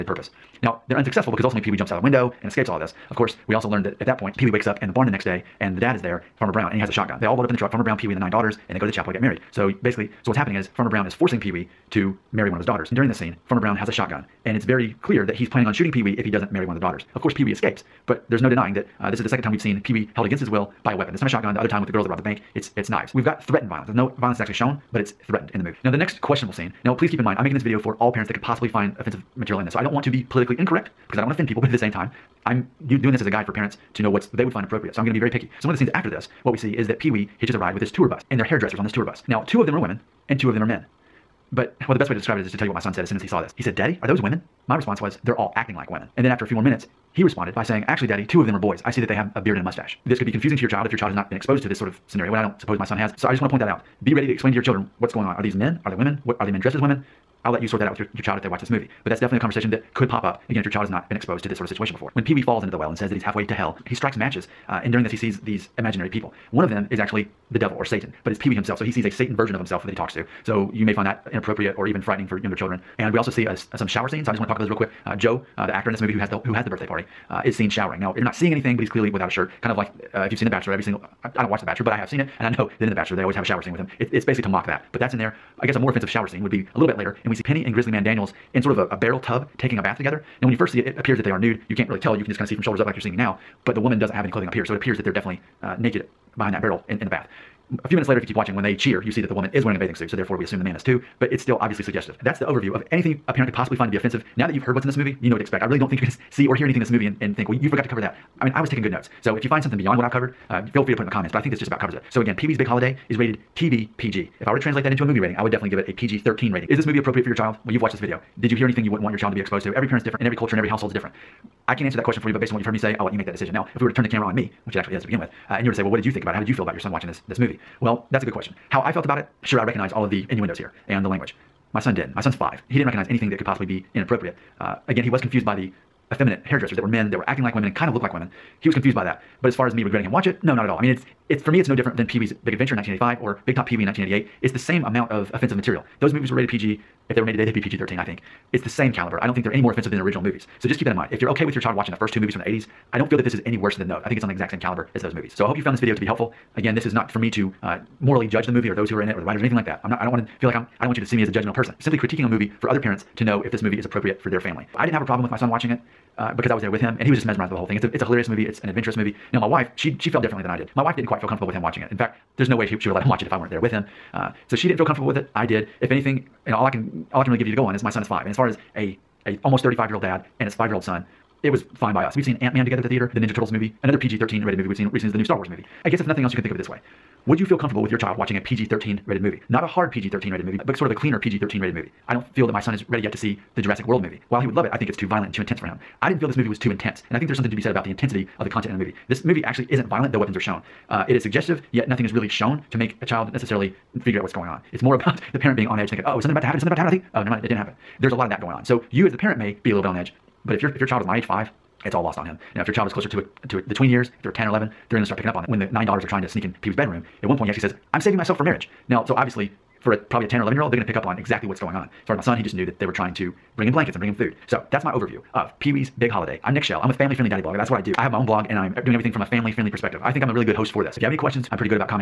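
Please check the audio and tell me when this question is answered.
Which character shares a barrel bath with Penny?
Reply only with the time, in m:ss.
1:27.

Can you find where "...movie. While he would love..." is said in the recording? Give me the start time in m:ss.
3:14.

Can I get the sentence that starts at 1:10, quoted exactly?
So you may find that inappropriate or even frightening for younger children.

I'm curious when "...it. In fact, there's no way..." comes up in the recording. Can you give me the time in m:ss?
2:51.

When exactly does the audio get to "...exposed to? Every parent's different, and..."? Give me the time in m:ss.
1:59.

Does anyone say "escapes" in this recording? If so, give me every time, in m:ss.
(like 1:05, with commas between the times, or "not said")
0:02, 0:17.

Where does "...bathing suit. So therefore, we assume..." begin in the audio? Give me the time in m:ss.
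1:39.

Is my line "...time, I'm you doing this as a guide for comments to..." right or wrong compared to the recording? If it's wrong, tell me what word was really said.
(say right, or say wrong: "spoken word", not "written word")
wrong: "parents", not "comments".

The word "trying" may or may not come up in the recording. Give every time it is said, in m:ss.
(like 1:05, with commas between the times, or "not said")
3:36, 3:42.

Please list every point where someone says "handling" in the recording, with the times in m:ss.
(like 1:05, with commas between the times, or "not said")
not said.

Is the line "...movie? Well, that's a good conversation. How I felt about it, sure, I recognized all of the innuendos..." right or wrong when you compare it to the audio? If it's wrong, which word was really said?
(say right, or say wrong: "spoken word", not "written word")
wrong: "question", not "conversation".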